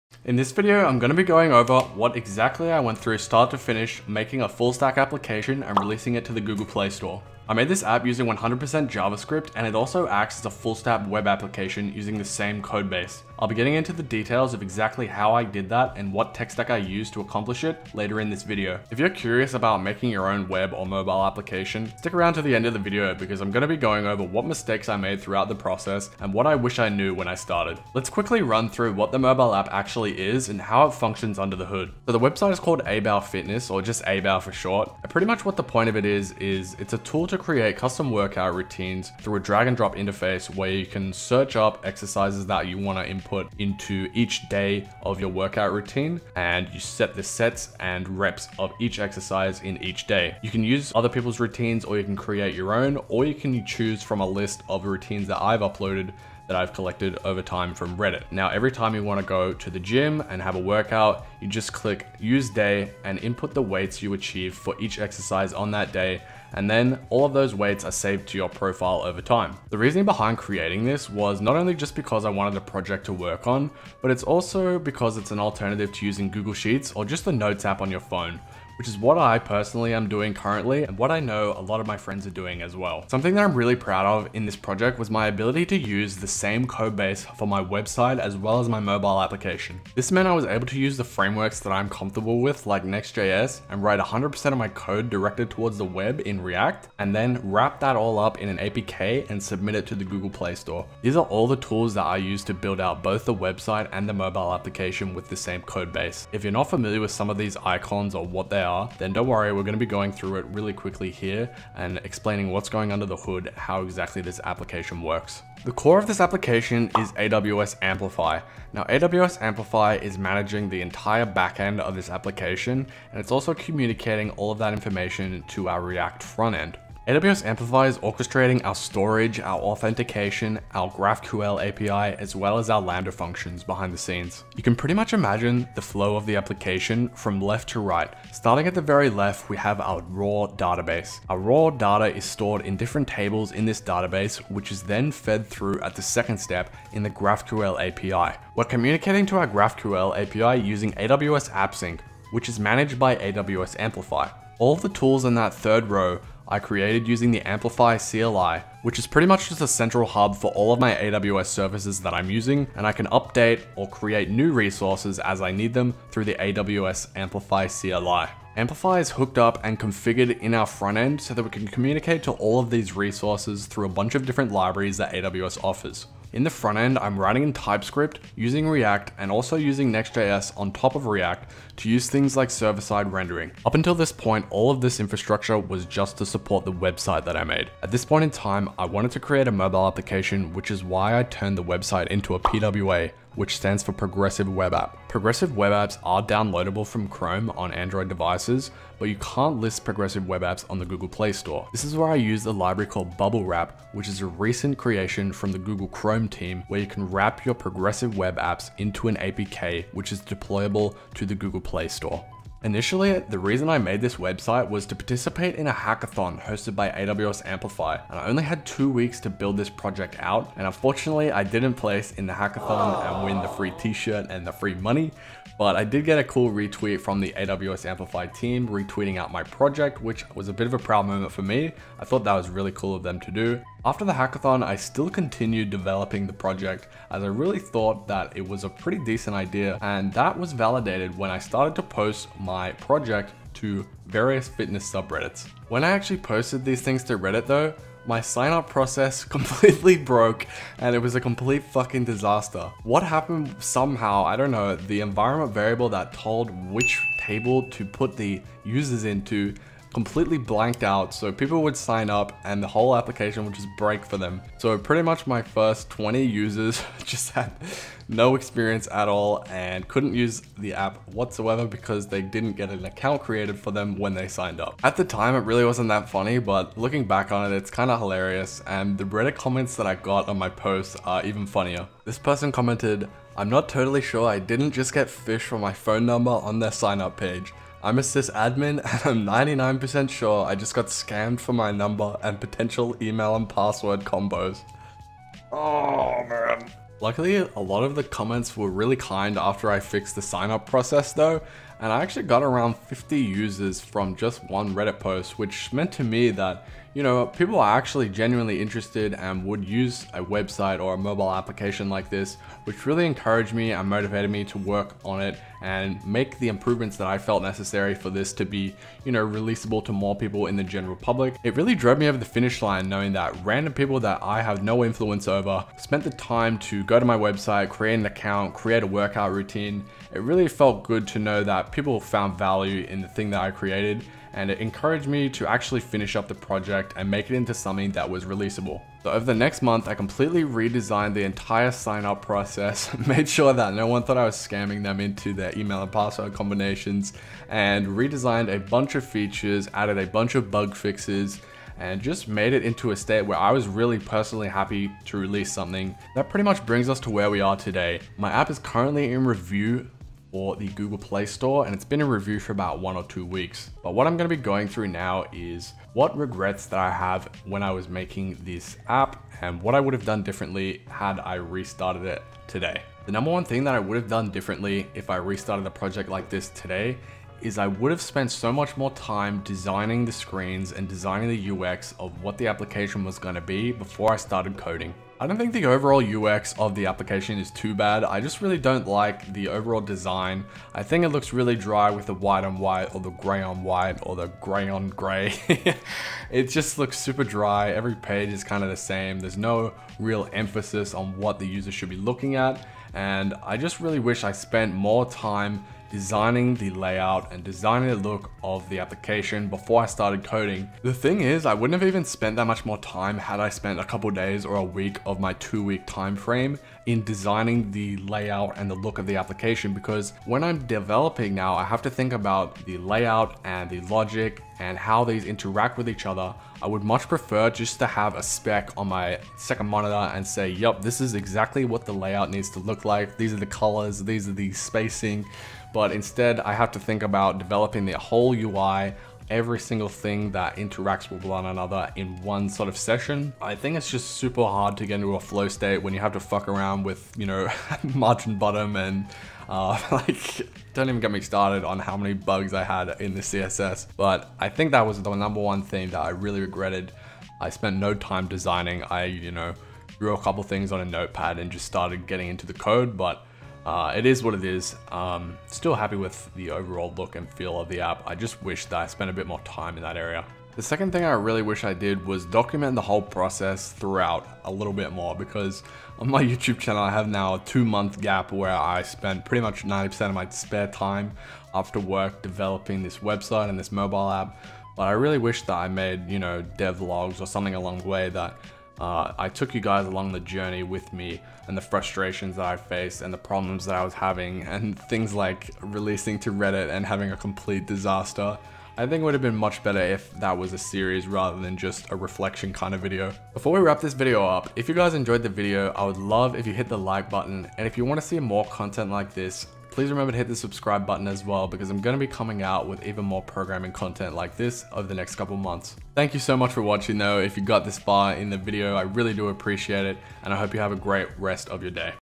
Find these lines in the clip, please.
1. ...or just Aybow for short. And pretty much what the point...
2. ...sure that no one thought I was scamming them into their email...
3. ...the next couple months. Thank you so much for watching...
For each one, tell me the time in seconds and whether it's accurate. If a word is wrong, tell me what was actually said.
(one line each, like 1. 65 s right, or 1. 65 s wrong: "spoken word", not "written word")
1. 33 s right
2. 343 s right
3. 514 s right.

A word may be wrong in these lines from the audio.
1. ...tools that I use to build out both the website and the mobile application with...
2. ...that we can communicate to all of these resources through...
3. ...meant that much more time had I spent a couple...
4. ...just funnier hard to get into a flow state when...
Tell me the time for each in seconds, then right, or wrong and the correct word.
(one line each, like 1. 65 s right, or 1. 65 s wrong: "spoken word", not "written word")
1. 101 s right
2. 171 s right
3. 412 s wrong: "spent", not "meant"
4. 443 s wrong: "super", not "funnier".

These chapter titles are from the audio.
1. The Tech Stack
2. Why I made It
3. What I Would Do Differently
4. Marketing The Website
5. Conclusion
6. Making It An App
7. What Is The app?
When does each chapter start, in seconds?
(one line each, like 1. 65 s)
1. 82 s
2. 70 s
3. 355 s
4. 240 s
5. 501 s
6. 188 s
7. 32 s.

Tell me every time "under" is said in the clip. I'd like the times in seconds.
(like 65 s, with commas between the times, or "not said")
31 s, 112 s.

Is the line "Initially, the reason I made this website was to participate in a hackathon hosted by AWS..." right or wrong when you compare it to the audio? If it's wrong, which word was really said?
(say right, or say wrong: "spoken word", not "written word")
right.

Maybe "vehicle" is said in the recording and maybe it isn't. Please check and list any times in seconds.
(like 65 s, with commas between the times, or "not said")
not said.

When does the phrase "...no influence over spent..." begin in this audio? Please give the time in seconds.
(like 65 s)
324 s.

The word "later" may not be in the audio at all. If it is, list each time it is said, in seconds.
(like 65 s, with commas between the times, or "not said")
17 s.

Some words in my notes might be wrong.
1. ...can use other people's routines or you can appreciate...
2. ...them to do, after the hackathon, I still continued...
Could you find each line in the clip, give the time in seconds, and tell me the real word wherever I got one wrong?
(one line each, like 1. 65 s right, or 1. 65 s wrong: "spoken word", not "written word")
1. 50 s wrong: "create", not "appreciate"
2. 233 s right.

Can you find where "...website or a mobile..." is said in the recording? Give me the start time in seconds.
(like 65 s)
310 s.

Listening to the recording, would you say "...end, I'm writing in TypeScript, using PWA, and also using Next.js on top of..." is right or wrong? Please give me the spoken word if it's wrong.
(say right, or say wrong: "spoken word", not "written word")
wrong: "React", not "PWA".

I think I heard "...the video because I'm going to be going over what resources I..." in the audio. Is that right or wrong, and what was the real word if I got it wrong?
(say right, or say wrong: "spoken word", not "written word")
wrong: "mistakes", not "resources".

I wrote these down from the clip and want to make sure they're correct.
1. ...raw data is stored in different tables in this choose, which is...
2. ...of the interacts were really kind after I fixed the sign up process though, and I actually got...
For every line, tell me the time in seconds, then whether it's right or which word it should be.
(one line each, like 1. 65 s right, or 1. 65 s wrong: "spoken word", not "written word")
1. 141 s wrong: "database", not "choose"
2. 297 s wrong: "comments", not "interacts".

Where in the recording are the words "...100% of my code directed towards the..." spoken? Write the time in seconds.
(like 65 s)
93 s.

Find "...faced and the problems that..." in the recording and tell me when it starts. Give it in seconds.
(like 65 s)
492 s.